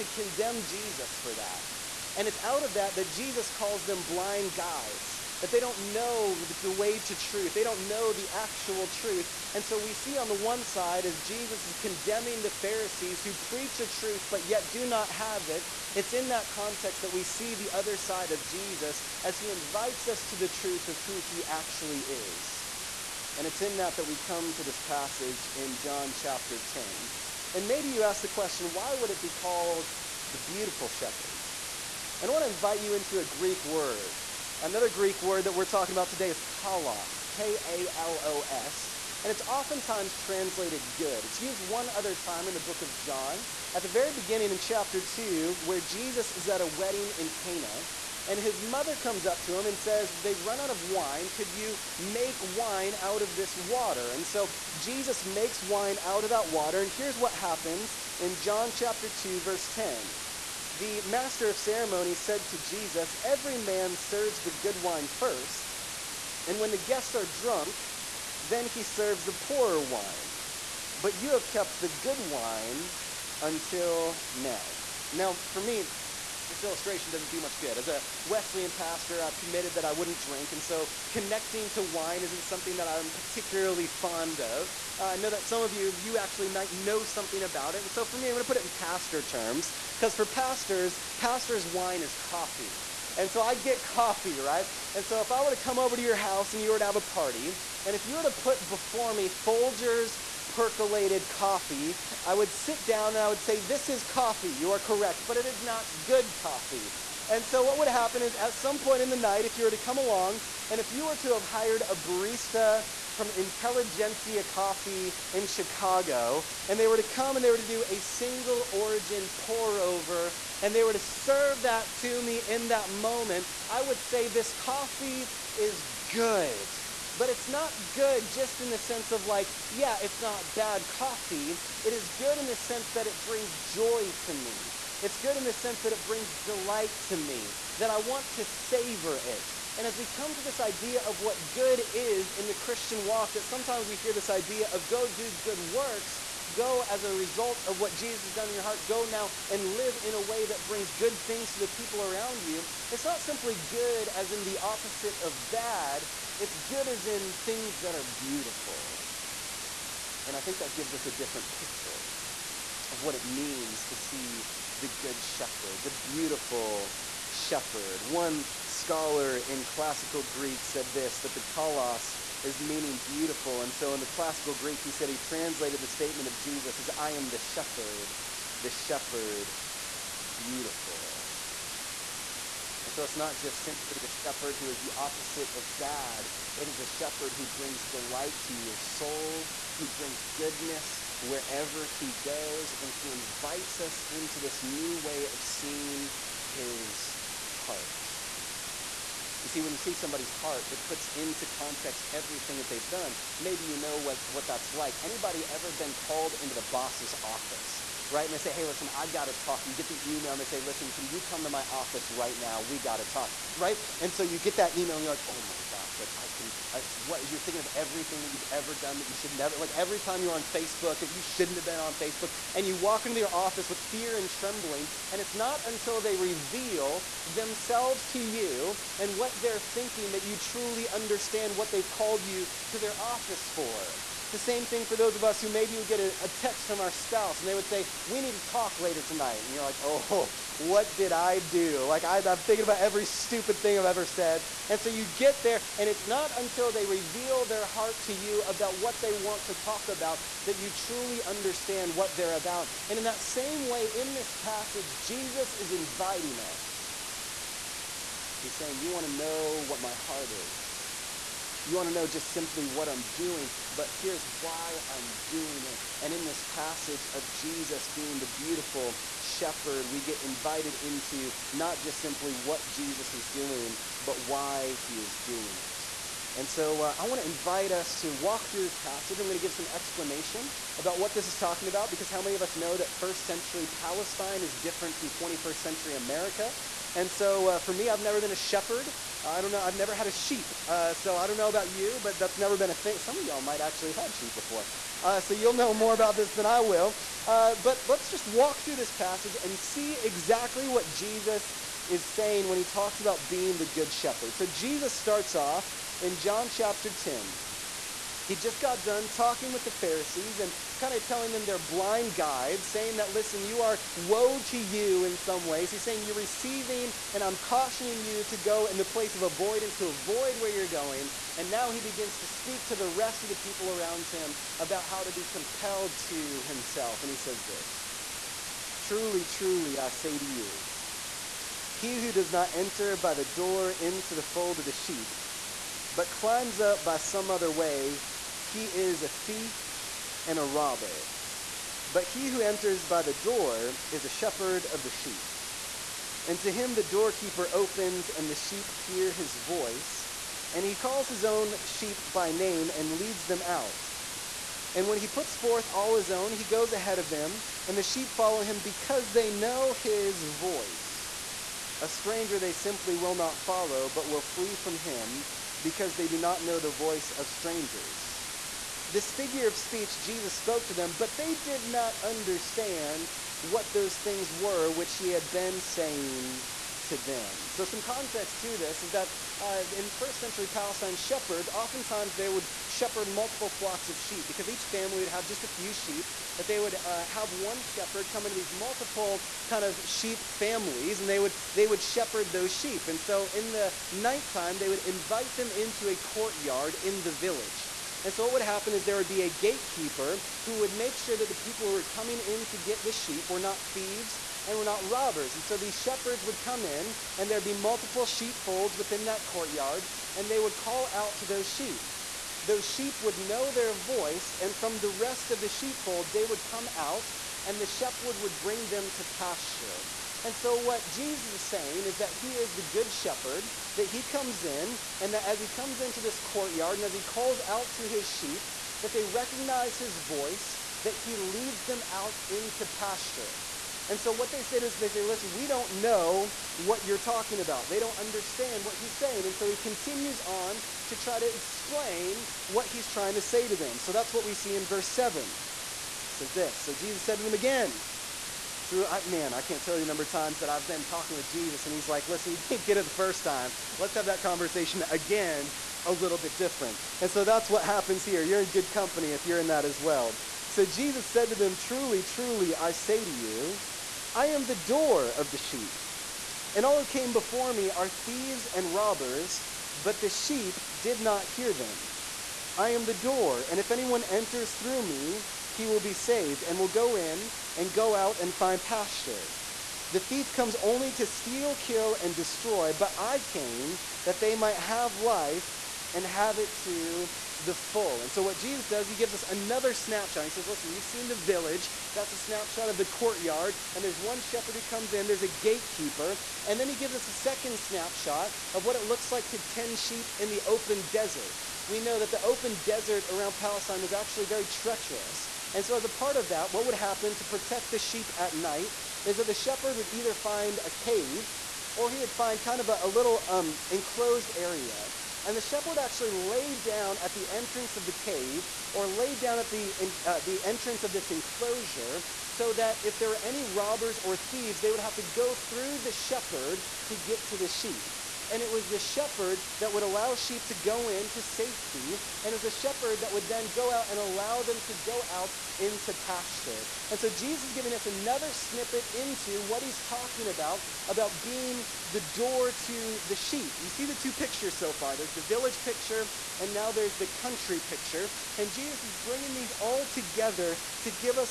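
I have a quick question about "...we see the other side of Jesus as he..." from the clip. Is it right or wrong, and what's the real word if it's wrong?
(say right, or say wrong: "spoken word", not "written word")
right.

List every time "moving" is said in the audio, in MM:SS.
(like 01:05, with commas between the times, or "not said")
not said.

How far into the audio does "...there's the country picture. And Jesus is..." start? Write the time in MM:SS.
09:06.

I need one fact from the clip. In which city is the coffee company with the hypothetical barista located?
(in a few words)
Chicago.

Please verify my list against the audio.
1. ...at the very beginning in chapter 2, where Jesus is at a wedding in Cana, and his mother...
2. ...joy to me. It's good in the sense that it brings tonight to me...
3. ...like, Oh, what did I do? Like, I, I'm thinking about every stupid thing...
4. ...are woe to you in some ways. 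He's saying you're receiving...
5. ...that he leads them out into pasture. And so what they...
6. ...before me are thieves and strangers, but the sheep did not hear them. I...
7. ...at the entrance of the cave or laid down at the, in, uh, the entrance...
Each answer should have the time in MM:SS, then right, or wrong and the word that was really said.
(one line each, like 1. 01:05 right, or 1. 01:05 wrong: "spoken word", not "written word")
1. 00:43 right
2. 02:13 wrong: "delight", not "tonight"
3. 03:59 right
4. 05:13 right
5. 07:10 right
6. 07:47 wrong: "robbers", not "strangers"
7. 08:37 right.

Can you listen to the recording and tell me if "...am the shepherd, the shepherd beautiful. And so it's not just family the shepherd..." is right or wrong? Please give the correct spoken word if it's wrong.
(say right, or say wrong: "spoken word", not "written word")
wrong: "simply", not "family".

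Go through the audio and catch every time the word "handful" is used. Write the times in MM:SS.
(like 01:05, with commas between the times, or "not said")
not said.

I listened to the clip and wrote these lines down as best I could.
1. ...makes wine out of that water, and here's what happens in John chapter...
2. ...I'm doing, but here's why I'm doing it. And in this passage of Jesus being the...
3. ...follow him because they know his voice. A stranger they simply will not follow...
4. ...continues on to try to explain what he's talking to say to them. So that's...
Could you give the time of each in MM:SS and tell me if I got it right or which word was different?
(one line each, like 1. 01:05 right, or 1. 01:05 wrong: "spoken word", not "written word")
1. 00:55 right
2. 04:22 right
3. 05:58 right
4. 07:19 wrong: "trying", not "talking".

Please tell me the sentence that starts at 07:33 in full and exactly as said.
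Let's have that conversation again, a little bit different.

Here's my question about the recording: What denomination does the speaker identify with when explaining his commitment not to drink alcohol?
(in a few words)
Wesleyan.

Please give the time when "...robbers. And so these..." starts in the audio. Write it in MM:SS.
06:44.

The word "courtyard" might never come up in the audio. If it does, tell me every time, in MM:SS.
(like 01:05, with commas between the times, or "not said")
06:35, 06:49, 07:06, 08:12.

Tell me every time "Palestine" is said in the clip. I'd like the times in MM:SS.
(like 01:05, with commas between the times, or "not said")
04:43, 06:20, 08:23.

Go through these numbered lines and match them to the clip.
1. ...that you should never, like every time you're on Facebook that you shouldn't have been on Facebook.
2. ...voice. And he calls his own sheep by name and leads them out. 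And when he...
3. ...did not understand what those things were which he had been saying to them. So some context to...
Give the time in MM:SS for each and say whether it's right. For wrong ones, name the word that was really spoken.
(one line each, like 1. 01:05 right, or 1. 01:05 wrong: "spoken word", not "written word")
1. 03:38 right
2. 05:49 right
3. 06:11 right.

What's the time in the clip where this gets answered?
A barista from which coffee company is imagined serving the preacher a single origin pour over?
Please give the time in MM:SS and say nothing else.
01:53.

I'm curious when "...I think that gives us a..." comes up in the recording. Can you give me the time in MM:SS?
02:40.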